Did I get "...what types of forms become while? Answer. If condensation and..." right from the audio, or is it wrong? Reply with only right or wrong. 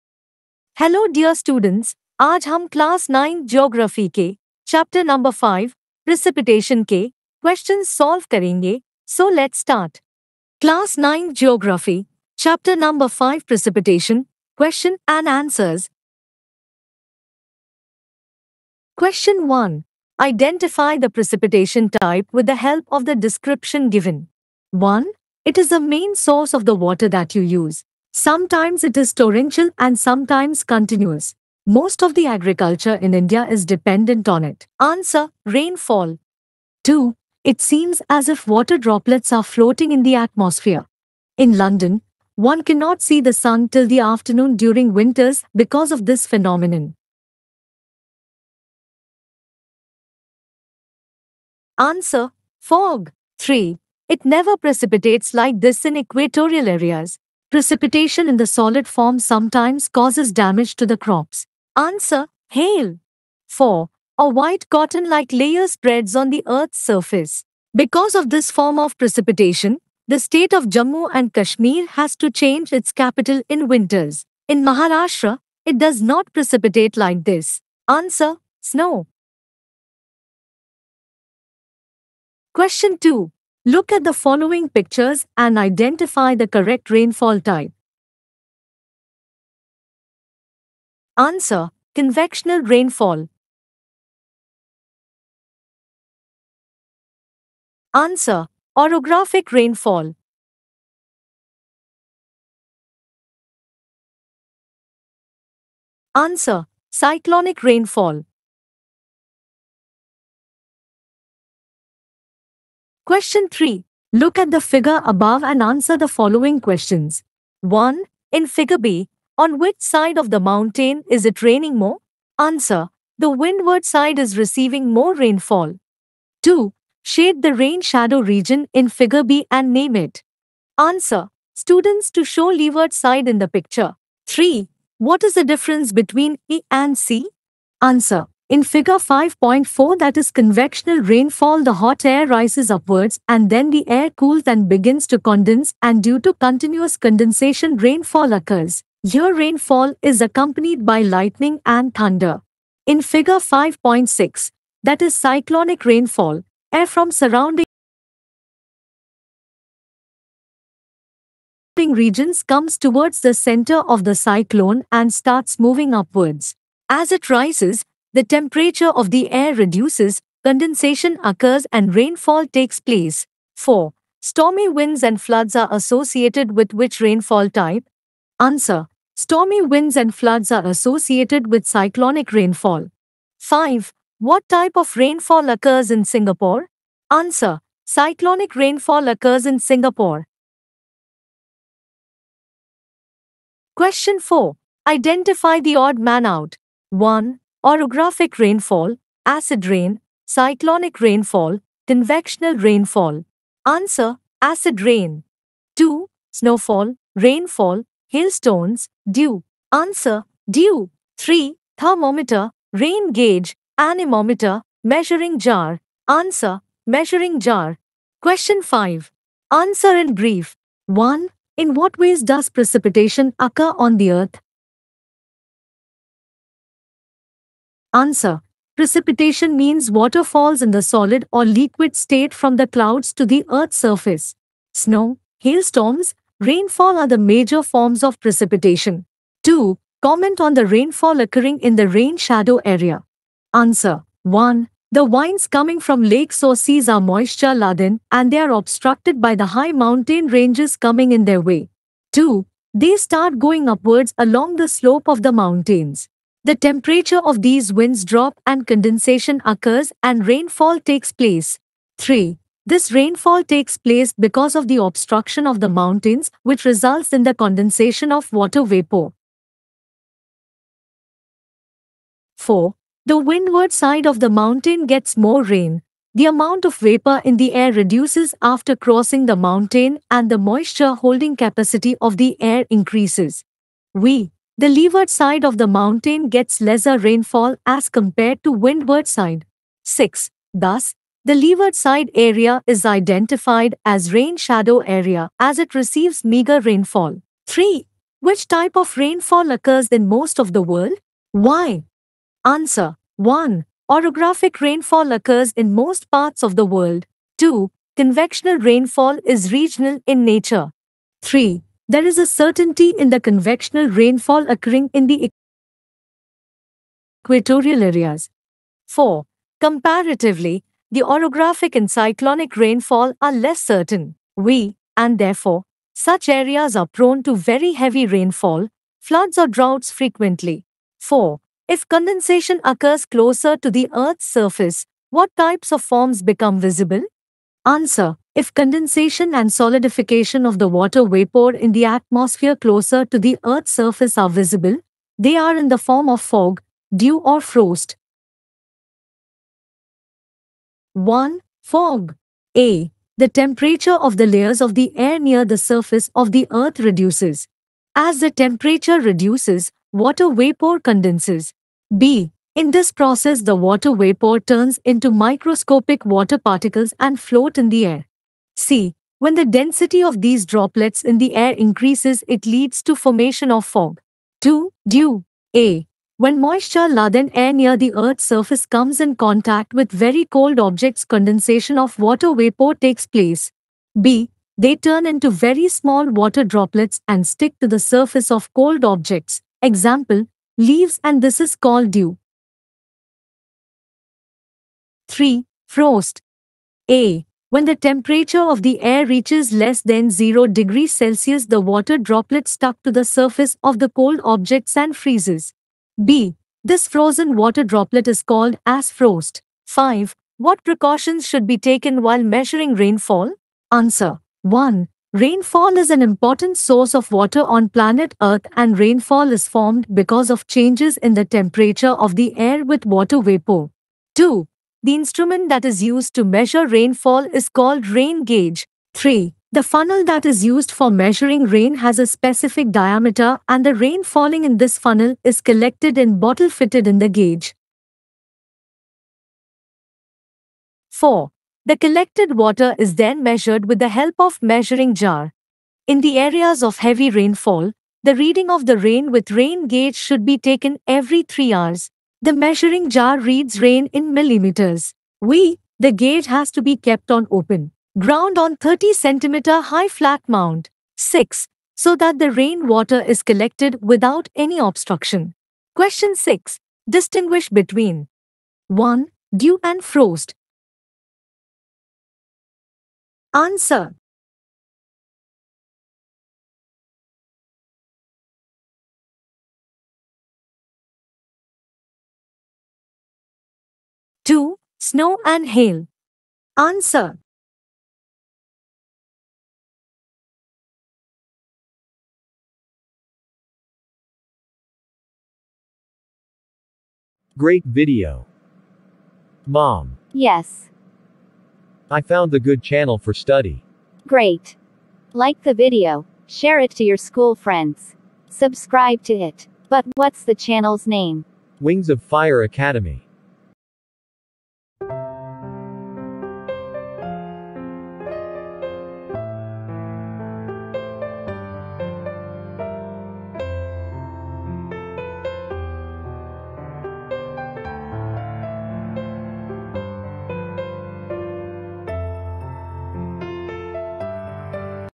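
wrong.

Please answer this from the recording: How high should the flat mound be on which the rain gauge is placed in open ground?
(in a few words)
30 centimeters.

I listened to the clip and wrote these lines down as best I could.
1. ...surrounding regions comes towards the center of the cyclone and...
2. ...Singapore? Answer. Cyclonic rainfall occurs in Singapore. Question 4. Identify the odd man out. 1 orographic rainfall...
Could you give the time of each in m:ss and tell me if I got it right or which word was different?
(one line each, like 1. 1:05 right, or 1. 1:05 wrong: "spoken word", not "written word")
1. 2:37 right
2. 3:06 right.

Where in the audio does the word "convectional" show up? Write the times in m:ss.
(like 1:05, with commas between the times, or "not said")
1:31, 2:20, 3:21, 5:07, 5:13.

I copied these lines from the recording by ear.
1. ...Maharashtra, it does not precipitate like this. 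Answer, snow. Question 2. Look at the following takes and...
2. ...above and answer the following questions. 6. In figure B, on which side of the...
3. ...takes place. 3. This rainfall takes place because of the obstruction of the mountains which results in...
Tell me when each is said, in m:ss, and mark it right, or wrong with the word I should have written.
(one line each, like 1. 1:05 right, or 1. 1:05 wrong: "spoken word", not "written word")
1. 1:14 wrong: "pictures", not "takes"
2. 1:55 wrong: "1", not "6"
3. 4:20 right.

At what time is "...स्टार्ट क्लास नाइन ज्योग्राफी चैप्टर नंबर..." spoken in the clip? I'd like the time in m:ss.
0:09.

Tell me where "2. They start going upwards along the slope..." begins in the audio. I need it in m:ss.
4:12.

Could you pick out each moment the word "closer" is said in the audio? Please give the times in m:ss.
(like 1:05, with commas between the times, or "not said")
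5:33, 5:42.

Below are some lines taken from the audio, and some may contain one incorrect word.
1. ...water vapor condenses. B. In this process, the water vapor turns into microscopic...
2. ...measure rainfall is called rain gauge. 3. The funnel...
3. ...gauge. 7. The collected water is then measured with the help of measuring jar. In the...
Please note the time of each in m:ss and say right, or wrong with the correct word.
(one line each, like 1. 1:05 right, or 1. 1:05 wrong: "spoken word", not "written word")
1. 5:59 right
2. 7:06 right
3. 7:17 wrong: "4", not "7".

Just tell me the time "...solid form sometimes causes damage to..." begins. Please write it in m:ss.
0:58.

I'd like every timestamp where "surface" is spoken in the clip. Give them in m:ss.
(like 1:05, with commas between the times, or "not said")
1:06, 3:53, 5:34, 5:43, 5:55, 6:18, 6:27, 6:43.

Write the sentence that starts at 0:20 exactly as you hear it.
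Identify the precipitation type with the help of the description given.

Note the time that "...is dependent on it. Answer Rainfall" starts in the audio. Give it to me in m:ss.
0:33.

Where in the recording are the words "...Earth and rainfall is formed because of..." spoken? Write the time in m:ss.
6:58.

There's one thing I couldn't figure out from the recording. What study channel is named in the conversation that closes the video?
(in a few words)
Wings of Fire Academy.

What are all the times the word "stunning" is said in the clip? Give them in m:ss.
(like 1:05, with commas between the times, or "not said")
not said.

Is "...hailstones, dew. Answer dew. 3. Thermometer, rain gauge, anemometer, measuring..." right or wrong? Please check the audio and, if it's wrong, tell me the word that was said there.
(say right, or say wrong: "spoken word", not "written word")
right.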